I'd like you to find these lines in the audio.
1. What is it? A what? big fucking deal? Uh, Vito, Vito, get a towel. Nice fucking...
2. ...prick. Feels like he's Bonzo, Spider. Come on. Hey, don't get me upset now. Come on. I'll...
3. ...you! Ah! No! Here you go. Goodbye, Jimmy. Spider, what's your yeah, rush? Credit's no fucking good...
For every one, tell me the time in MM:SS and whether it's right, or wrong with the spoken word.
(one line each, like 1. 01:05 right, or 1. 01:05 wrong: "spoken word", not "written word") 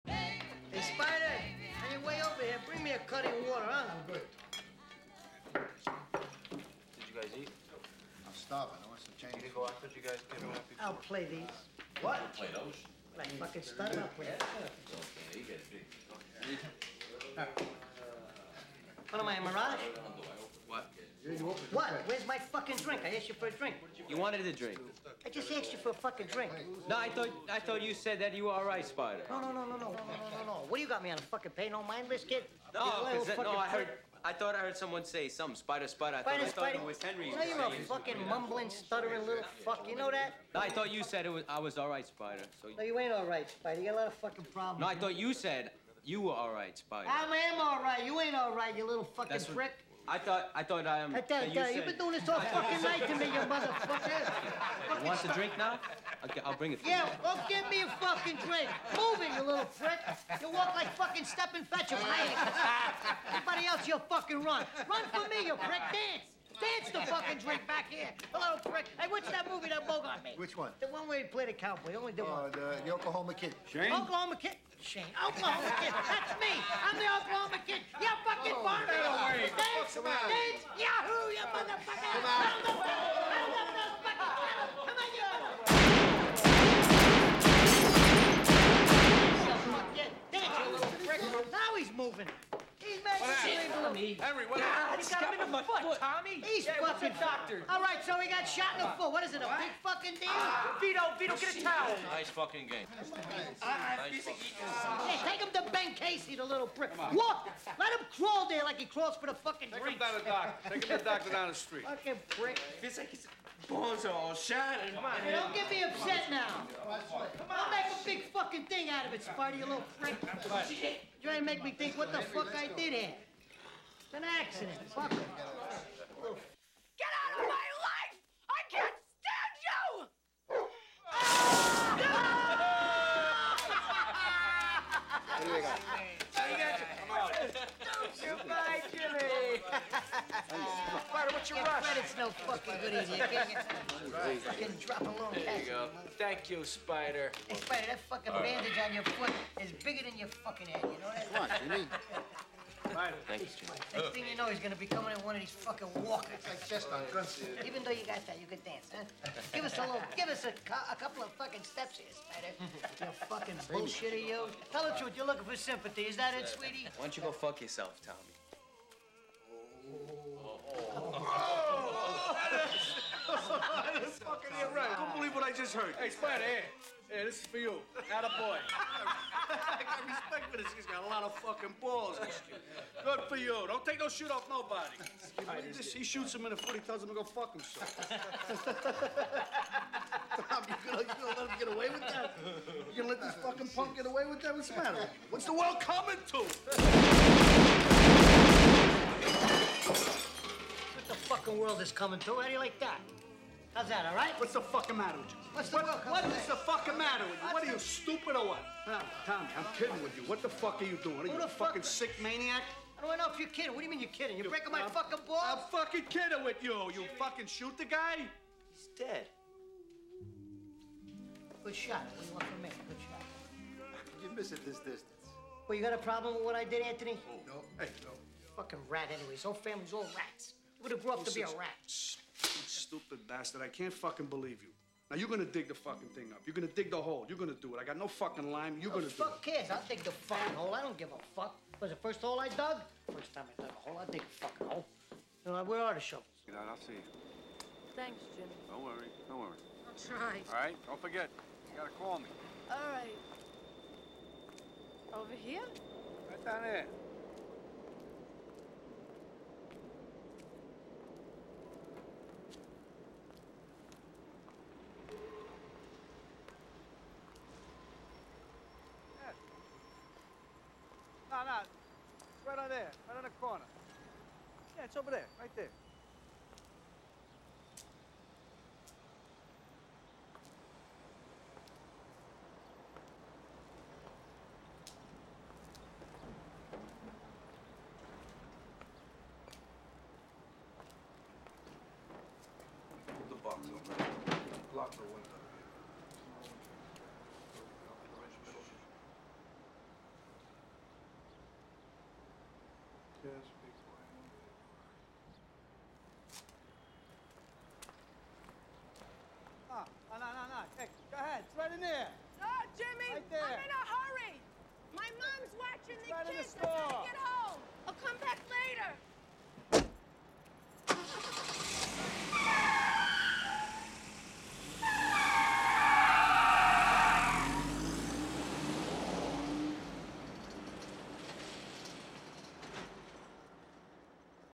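1. 01:39 right
2. 01:52 wrong: "Shannon", not "Spider"
3. 02:09 right.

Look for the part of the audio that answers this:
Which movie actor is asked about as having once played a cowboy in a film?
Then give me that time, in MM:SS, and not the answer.
01:09.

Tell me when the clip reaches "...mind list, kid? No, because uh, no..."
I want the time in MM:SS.
00:31.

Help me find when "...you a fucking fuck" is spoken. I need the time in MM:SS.
03:31.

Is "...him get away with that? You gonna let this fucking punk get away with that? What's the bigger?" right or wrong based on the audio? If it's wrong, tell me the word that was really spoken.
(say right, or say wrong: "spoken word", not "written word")
wrong: "matter", not "bigger".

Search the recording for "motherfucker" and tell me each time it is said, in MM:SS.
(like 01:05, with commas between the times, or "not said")
00:53, 01:21.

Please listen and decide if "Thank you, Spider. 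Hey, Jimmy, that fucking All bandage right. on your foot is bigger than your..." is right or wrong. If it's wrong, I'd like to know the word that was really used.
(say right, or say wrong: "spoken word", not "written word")
wrong: "Spider", not "Jimmy".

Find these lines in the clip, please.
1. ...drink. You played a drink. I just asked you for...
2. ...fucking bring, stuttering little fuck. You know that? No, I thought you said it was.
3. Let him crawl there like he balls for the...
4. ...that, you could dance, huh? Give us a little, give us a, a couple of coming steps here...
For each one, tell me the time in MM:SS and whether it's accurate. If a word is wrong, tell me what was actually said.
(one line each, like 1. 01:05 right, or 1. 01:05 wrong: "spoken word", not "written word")
1. 00:23 wrong: "wanted", not "played"
2. 00:37 wrong: "mumbling", not "bring"
3. 01:47 wrong: "crawls", not "balls"
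4. 02:38 wrong: "fucking", not "coming".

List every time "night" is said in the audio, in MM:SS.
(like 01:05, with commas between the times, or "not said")
00:52.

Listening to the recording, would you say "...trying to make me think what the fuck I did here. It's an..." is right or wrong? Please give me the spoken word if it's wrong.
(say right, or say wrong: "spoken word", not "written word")
right.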